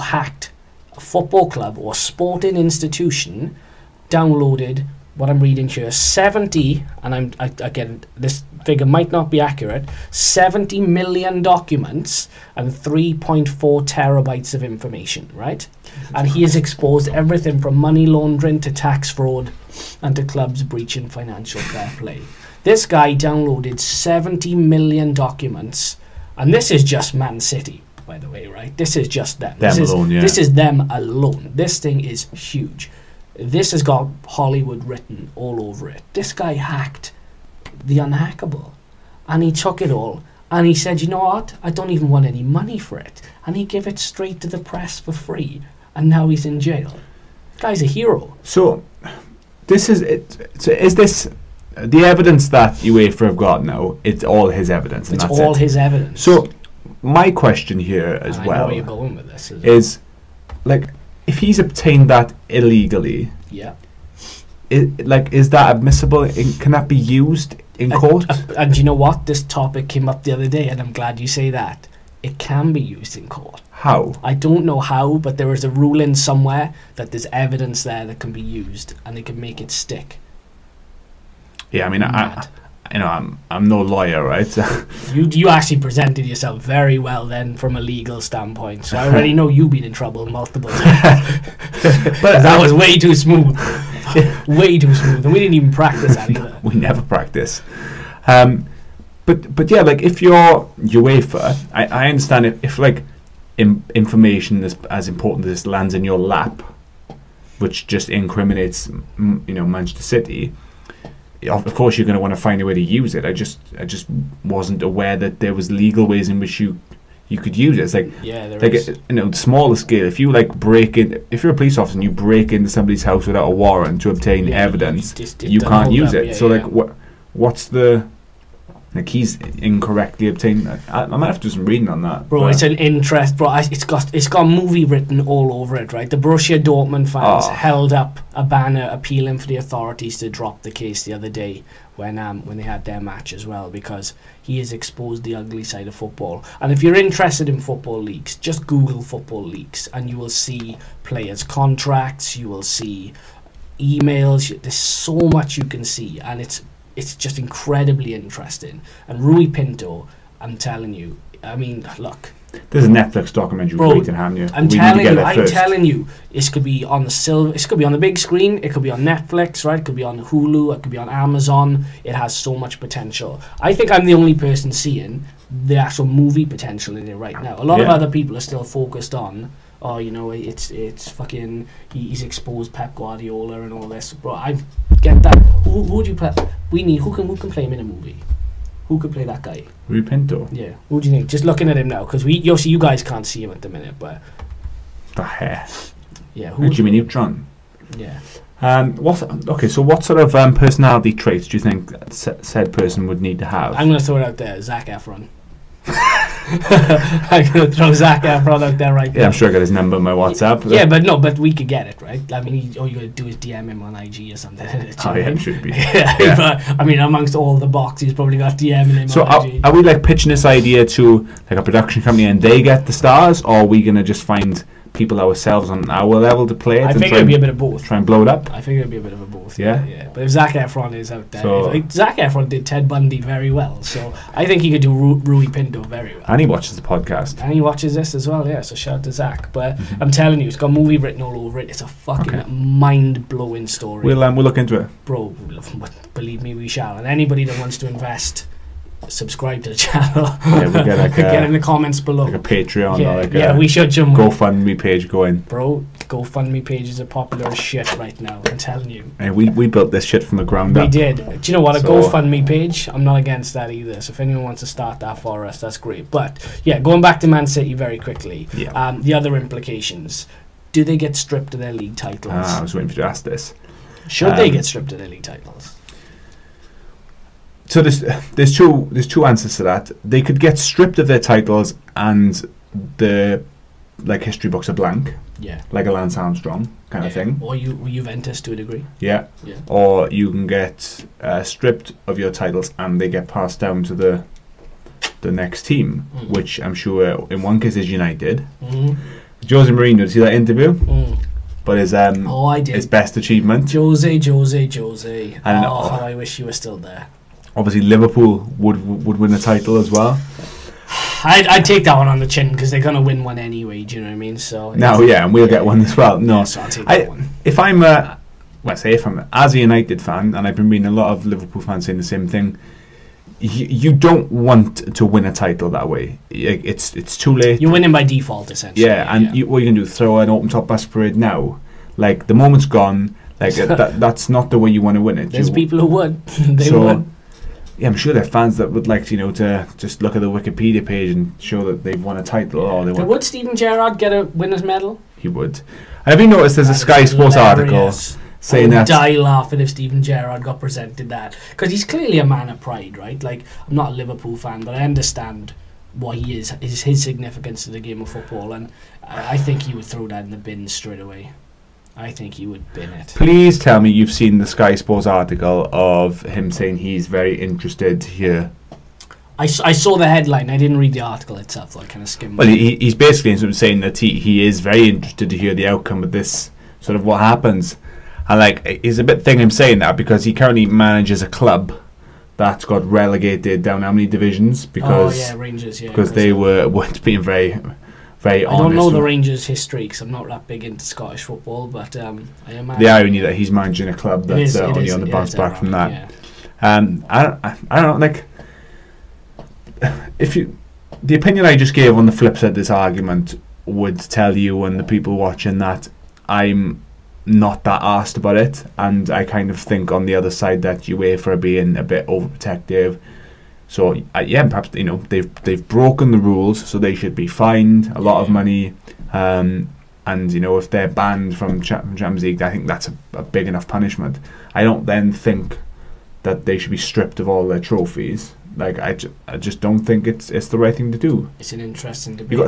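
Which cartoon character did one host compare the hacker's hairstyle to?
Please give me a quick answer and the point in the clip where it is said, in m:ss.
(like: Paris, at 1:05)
Jimmy Neutron, at 3:16.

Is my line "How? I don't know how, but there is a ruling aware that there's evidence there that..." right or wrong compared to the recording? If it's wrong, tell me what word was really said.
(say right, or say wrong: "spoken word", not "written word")
wrong: "somewhere", not "aware".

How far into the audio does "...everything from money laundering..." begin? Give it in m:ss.
0:17.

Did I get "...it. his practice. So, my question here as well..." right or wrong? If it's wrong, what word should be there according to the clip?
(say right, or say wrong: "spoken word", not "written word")
wrong: "evidence", not "practice".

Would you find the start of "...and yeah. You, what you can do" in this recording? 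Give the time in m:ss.
5:29.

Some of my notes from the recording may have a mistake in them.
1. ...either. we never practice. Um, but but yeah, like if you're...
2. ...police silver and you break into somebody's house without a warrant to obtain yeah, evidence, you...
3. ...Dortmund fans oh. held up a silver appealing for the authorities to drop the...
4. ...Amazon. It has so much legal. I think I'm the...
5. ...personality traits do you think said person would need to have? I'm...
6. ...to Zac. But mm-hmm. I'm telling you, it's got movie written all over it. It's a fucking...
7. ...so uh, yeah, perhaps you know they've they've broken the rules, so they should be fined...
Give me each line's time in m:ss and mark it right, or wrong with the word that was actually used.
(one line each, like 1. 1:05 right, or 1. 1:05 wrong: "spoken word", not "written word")
1. 1:36 right
2. 2:01 wrong: "officer", not "silver"
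3. 2:16 wrong: "banner", not "silver"
4. 2:51 wrong: "potential", not "legal"
5. 3:20 right
6. 3:59 right
7. 6:53 right.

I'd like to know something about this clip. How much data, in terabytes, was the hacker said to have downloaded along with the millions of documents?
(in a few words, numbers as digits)
3.4 terabytes.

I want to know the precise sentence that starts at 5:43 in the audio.
Would Steven Gerrard get a winner's medal?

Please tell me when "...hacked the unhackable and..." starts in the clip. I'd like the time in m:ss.
0:36.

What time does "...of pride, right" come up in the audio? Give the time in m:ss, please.
5:52.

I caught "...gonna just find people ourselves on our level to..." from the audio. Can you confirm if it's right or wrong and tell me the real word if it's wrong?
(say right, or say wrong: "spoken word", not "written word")
right.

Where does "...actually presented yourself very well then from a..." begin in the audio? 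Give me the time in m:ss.
1:25.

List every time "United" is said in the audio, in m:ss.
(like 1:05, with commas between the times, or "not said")
4:57, 5:19.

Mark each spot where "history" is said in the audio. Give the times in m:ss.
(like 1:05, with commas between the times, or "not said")
4:44, 6:29.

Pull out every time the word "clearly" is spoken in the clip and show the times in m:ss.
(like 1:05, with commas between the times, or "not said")
5:51.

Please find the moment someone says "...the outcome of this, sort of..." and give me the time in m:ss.
6:15.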